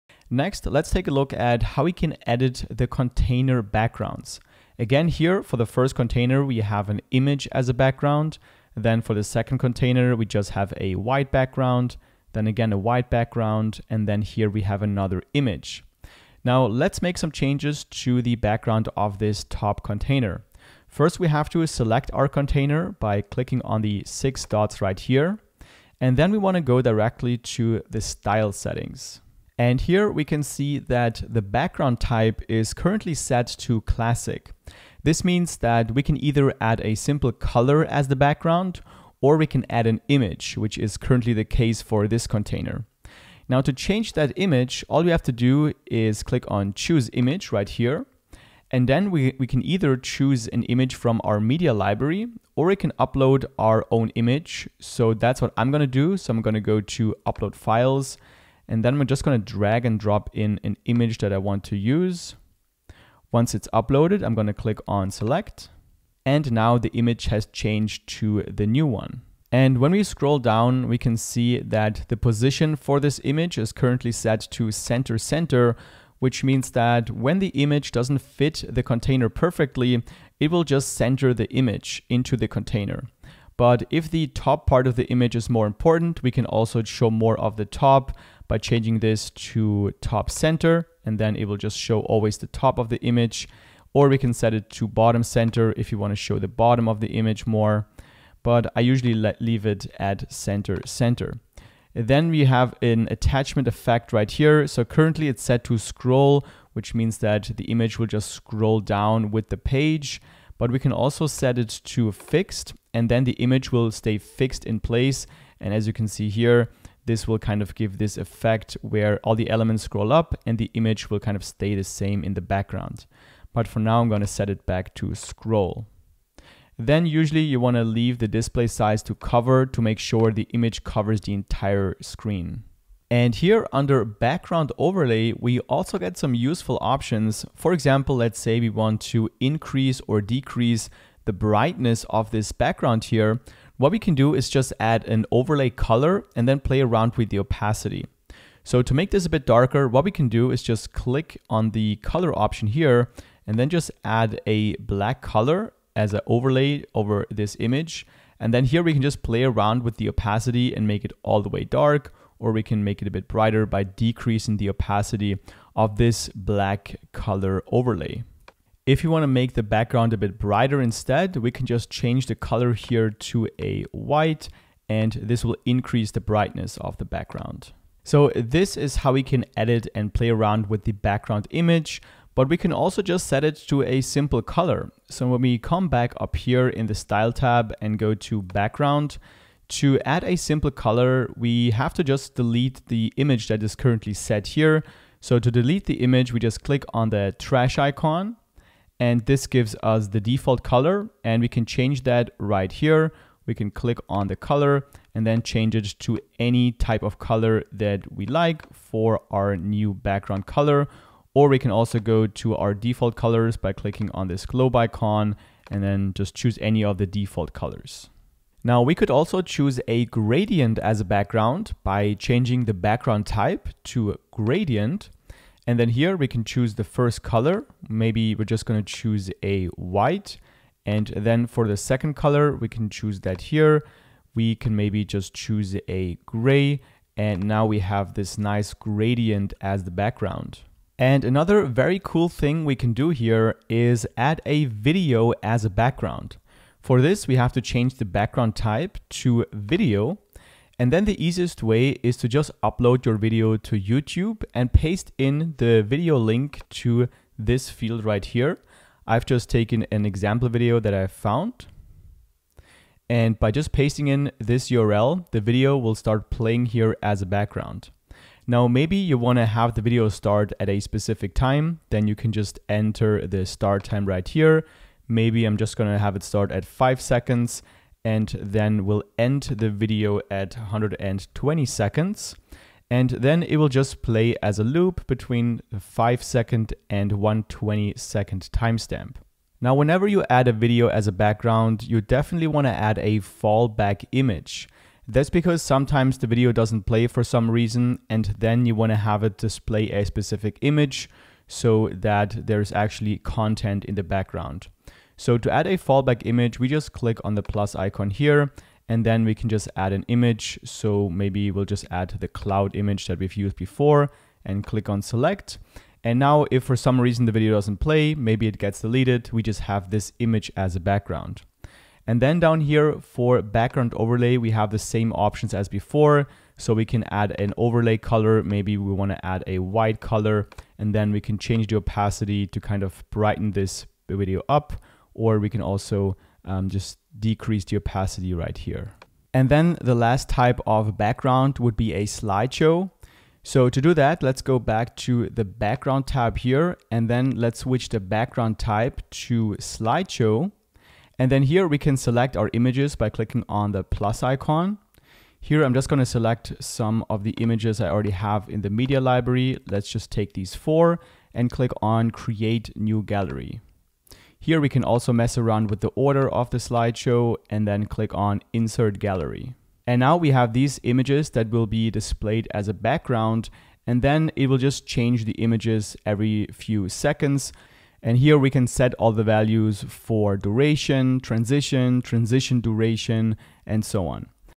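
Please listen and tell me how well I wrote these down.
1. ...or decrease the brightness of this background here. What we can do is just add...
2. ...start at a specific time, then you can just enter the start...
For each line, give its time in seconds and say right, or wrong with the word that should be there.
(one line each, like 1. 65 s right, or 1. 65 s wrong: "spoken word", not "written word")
1. 140 s right
2. 270 s right.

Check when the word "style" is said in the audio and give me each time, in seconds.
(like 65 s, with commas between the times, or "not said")
27 s, 186 s.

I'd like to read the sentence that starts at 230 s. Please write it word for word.
And then for the second color, we can choose that here.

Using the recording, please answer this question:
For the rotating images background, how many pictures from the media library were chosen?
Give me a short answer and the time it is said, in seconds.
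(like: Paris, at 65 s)
4, at 360 s.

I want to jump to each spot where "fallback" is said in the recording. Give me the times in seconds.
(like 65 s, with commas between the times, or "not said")
293 s, 305 s.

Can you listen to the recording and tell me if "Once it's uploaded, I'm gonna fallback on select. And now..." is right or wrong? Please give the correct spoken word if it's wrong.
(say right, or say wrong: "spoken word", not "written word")
wrong: "click", not "fallback".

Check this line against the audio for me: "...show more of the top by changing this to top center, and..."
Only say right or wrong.
right.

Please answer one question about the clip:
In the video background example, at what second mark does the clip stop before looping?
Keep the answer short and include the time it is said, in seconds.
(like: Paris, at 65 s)
120, at 280 s.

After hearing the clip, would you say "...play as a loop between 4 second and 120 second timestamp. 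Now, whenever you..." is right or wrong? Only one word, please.
wrong.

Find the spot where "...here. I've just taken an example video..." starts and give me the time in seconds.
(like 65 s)
258 s.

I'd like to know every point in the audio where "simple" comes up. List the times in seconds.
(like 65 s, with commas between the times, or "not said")
36 s, 184 s, 190 s.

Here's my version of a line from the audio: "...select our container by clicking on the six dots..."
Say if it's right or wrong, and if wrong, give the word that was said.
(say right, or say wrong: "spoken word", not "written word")
right.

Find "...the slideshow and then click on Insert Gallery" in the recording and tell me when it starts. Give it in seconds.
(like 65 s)
366 s.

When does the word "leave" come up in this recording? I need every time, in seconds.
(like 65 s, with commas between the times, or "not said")
99 s, 127 s.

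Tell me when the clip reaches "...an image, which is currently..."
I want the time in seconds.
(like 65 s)
39 s.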